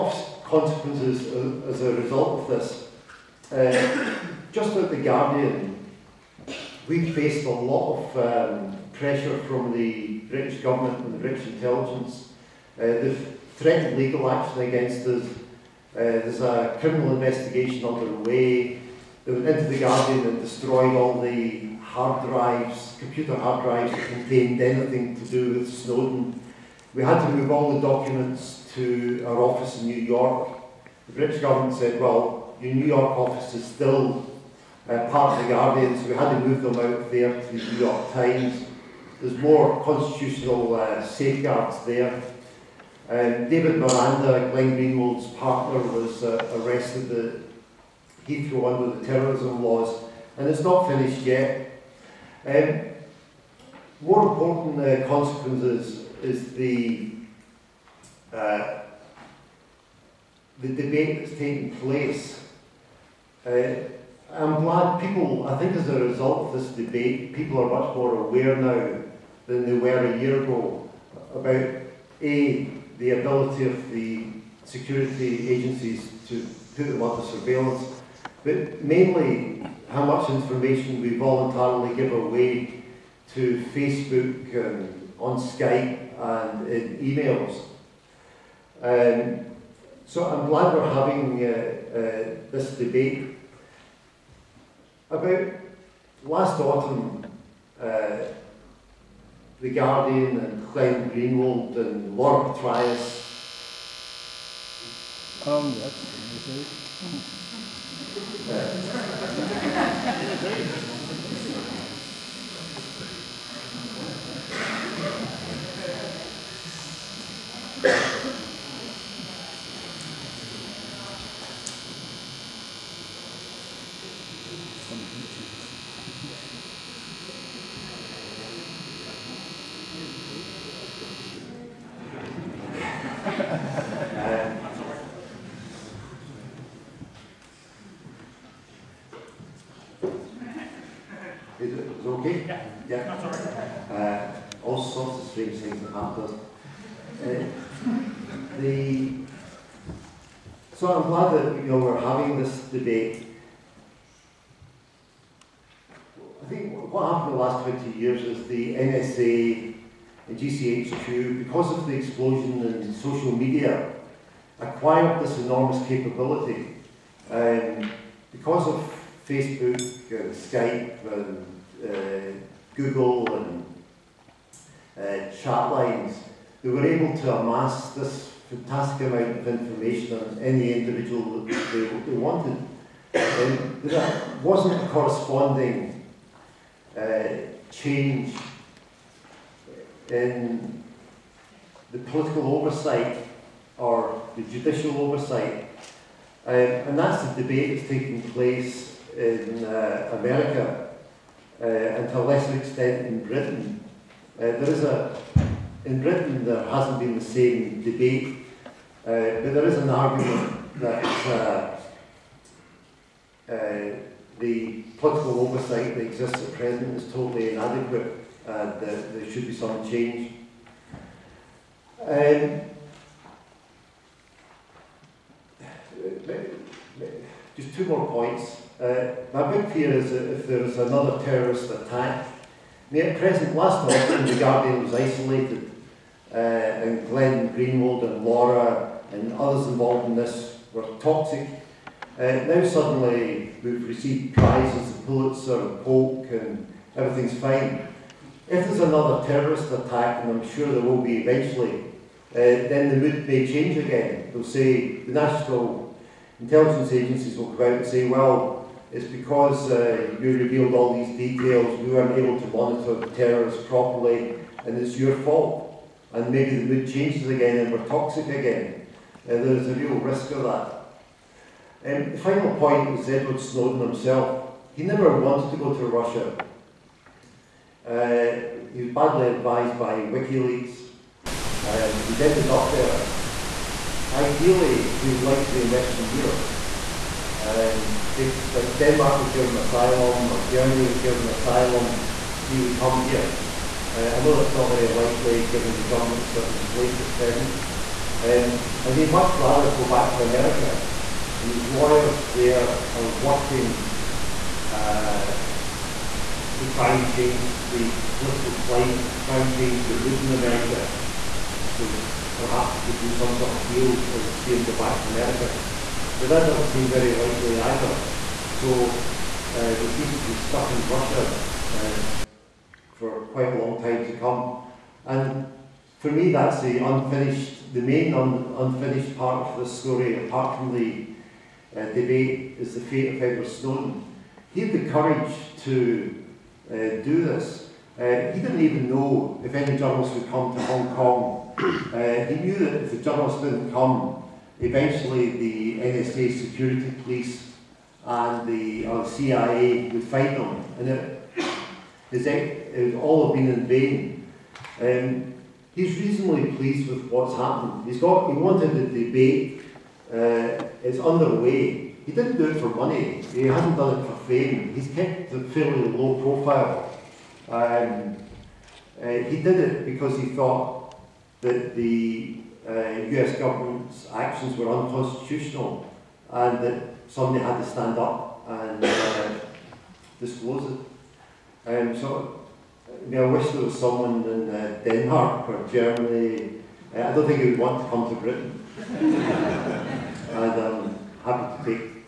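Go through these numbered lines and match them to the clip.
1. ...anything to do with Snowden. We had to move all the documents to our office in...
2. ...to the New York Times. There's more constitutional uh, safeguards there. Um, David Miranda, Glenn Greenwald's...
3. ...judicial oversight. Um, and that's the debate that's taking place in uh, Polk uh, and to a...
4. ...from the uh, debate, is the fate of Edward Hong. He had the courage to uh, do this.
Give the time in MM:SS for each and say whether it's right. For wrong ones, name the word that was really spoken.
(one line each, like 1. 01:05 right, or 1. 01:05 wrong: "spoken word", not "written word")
1. 00:24 right
2. 00:37 right
3. 03:14 wrong: "America", not "Polk"
4. 05:30 wrong: "Snowden", not "Hong".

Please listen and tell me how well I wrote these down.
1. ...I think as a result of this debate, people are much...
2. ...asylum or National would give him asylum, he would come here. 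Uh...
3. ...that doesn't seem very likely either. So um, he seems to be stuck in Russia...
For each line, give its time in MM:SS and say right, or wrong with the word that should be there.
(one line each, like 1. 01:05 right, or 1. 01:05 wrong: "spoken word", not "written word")
1. 01:05 right
2. 04:49 wrong: "Germany", not "National"
3. 05:16 right.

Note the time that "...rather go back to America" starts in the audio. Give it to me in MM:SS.
04:59.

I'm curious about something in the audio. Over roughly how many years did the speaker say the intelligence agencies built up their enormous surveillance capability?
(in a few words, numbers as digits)
20 years.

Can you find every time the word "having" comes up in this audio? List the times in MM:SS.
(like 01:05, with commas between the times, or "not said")
01:30, 02:31.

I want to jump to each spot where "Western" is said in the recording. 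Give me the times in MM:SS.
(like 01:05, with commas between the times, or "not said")
04:45.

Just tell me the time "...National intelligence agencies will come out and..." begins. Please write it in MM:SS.
04:15.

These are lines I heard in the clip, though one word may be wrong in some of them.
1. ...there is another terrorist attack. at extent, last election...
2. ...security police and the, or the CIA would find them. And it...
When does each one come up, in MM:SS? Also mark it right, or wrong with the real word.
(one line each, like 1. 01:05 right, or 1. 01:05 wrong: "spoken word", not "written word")
1. 03:50 wrong: "present", not "extent"
2. 05:46 right.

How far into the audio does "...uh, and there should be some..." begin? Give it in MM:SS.
03:38.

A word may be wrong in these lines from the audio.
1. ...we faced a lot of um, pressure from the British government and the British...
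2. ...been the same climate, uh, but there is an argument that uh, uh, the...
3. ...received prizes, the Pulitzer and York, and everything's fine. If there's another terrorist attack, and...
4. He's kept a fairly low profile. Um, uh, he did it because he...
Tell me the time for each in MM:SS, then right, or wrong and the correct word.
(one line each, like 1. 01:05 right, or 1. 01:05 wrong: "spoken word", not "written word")
1. 00:06 right
2. 03:26 wrong: "debate", not "climate"
3. 04:03 wrong: "Polk", not "York"
4. 06:04 right.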